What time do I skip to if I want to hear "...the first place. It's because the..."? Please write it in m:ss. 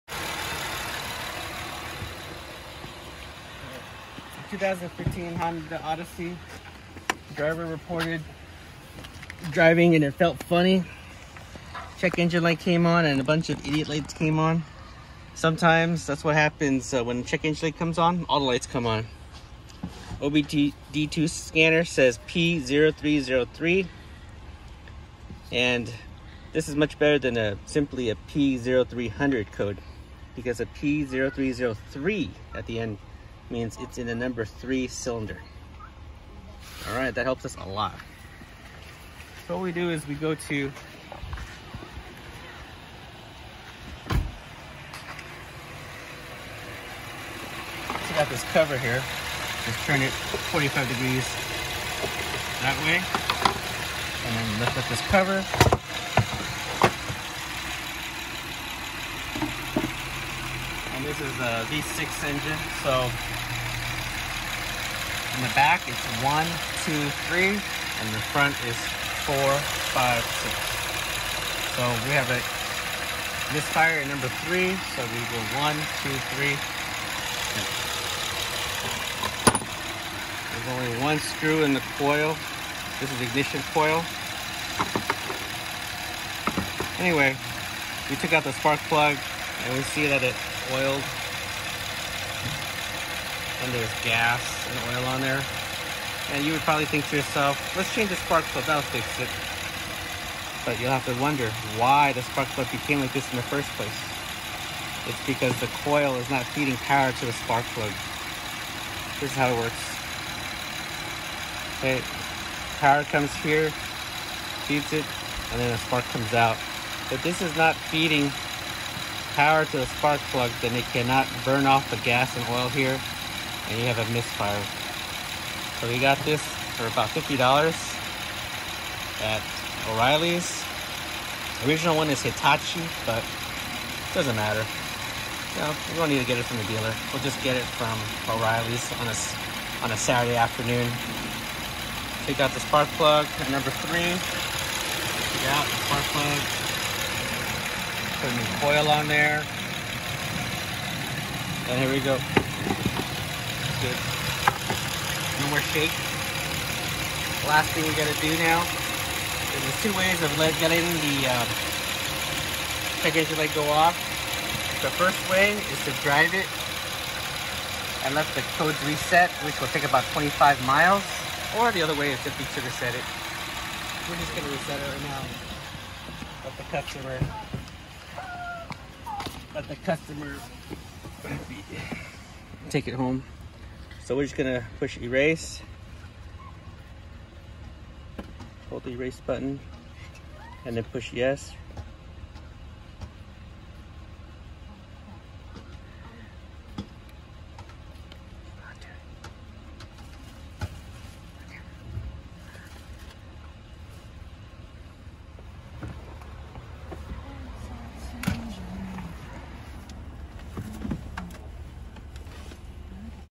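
1:43.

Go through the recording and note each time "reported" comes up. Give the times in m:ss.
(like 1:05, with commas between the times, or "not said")
0:07.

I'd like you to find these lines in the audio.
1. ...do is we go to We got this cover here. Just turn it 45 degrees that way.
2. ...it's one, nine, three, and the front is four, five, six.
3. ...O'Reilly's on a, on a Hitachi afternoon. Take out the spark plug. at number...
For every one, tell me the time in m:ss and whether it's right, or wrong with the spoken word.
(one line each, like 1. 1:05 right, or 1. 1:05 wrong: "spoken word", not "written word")
1. 0:39 right
2. 1:05 wrong: "two", not "nine"
3. 2:18 wrong: "Saturday", not "Hitachi".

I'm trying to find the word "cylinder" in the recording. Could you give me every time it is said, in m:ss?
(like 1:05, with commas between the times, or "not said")
0:34.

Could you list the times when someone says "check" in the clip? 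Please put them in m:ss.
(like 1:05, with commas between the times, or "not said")
0:11, 0:17.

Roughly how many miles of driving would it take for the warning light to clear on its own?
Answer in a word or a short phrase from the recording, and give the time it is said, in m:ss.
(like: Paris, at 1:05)
25 miles, at 2:50.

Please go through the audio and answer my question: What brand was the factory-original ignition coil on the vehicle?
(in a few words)
Hitachi.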